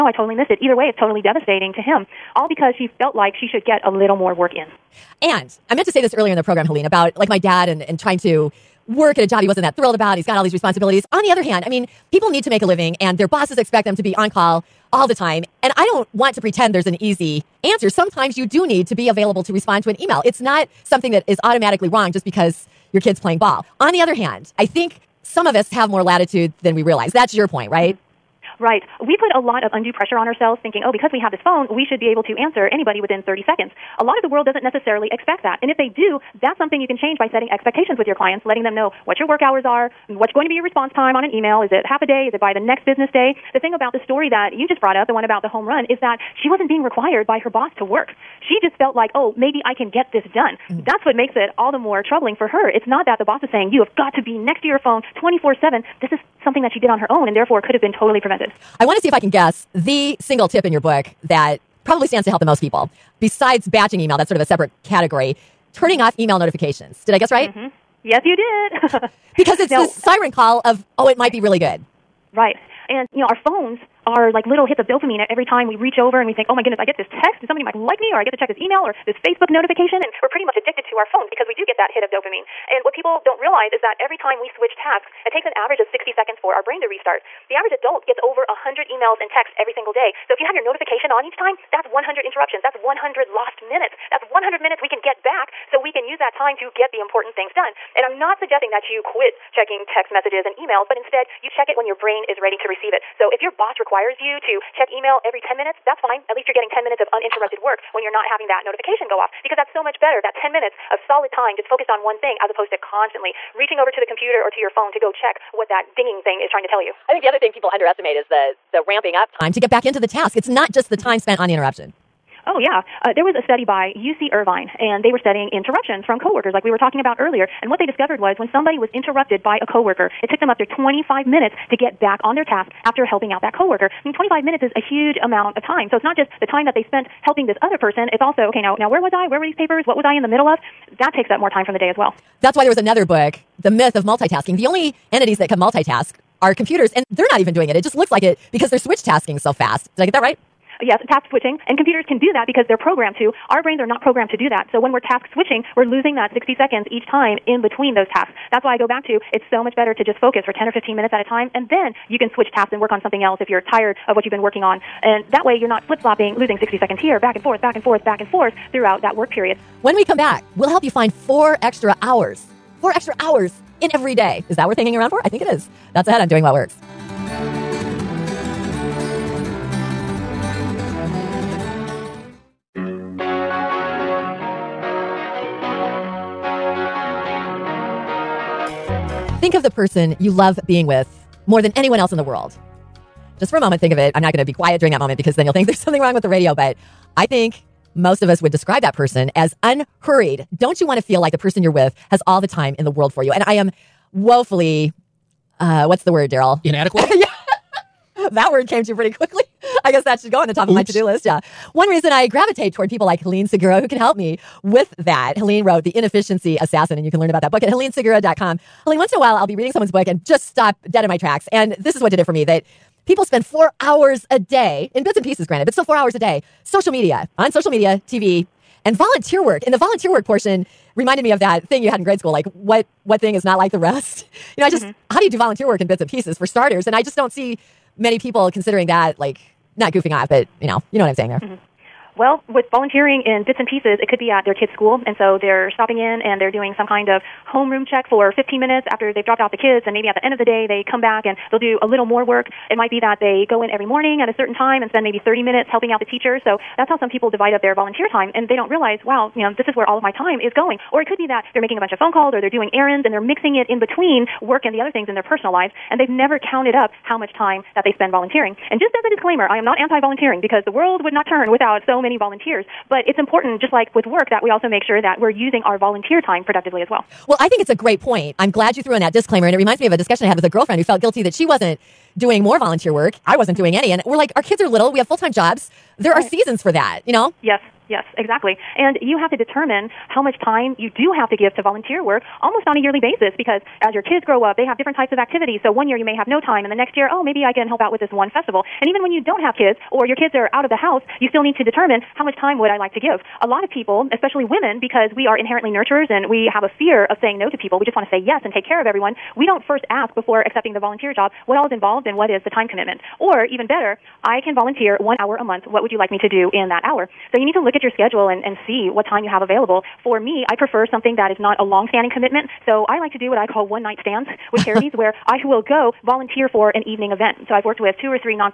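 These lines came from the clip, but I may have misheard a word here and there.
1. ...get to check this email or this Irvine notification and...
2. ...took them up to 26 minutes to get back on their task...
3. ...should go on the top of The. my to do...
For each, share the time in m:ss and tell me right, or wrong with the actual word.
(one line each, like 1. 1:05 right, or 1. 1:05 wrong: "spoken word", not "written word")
1. 1:18 wrong: "Facebook", not "Irvine"
2. 2:10 wrong: "25", not "26"
3. 3:30 wrong: "Oops", not "The".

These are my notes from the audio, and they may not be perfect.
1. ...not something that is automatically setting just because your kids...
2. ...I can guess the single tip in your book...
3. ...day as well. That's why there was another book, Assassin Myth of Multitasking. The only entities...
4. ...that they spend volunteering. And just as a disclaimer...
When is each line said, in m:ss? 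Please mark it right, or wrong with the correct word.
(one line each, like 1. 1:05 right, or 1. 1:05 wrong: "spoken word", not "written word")
1. 0:20 wrong: "wrong", not "setting"
2. 0:59 right
3. 2:21 wrong: "The", not "Assassin"
4. 4:27 right.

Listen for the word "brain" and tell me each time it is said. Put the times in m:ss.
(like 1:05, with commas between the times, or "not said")
1:26, 1:41, 2:33.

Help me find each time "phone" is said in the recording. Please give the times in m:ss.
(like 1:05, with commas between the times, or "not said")
0:31, 0:54, 1:13, 1:21, 1:54, 4:21.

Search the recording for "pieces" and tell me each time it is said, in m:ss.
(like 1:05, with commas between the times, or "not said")
3:45, 3:56, 4:03.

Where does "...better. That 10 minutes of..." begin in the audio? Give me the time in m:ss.
1:50.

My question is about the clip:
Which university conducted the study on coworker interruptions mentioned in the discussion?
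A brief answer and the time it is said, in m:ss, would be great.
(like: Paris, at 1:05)
UC Irvine, at 2:03.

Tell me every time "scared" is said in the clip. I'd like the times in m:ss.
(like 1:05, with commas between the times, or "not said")
not said.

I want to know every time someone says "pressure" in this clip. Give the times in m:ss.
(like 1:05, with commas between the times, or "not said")
0:29.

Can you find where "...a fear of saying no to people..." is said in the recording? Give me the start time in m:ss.
5:06.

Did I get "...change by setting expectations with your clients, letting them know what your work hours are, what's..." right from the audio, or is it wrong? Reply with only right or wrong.
right.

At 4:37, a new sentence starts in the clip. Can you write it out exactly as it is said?
Well, I think it's a great point.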